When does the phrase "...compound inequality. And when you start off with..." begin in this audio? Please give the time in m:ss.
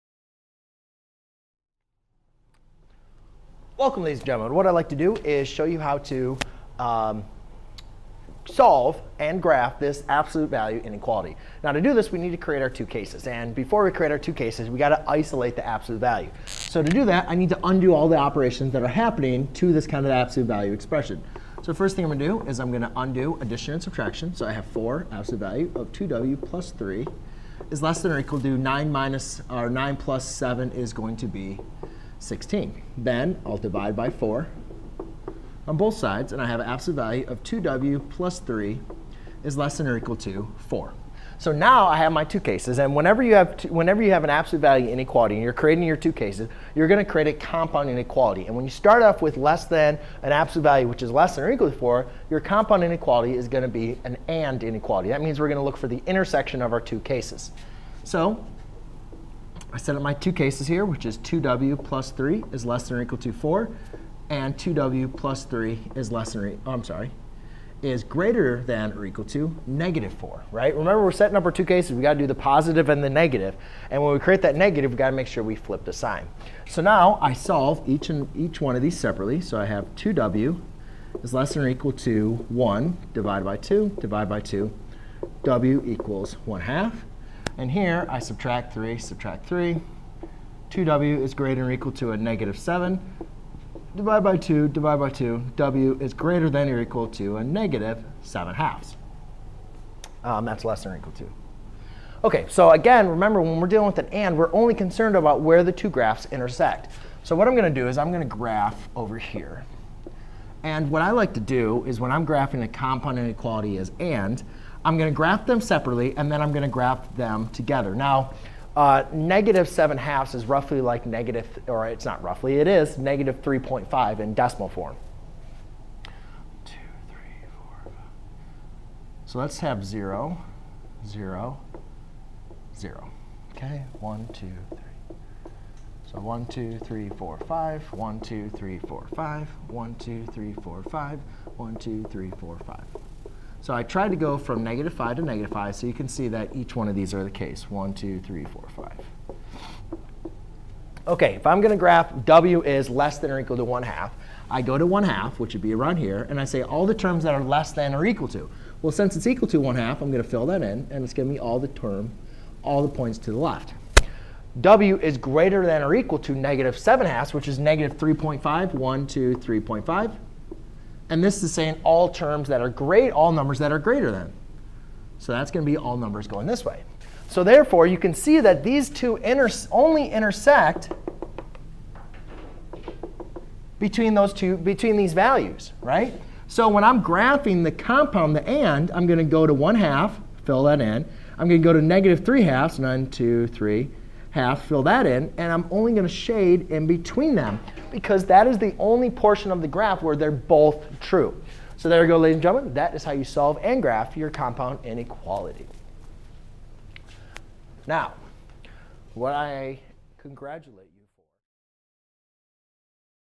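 0:47.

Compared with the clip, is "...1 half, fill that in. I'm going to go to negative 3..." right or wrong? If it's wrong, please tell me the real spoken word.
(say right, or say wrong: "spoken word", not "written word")
right.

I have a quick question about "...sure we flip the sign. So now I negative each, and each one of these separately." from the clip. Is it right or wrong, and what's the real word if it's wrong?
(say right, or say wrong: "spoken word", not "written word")
wrong: "solve", not "negative".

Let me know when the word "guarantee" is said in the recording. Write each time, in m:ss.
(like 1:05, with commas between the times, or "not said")
not said.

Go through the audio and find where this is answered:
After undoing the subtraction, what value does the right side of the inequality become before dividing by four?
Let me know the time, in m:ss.
0:32.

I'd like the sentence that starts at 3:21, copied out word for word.
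So there you go, ladies and gentlemen.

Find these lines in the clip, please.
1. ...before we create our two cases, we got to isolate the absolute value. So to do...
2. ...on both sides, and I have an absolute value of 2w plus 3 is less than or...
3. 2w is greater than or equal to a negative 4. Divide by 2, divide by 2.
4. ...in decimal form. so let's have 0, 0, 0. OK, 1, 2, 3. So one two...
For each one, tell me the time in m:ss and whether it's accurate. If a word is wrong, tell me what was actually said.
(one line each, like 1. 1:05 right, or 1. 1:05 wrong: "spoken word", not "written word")
1. 0:13 right
2. 0:35 right
3. 1:30 wrong: "7", not "4"
4. 2:04 right.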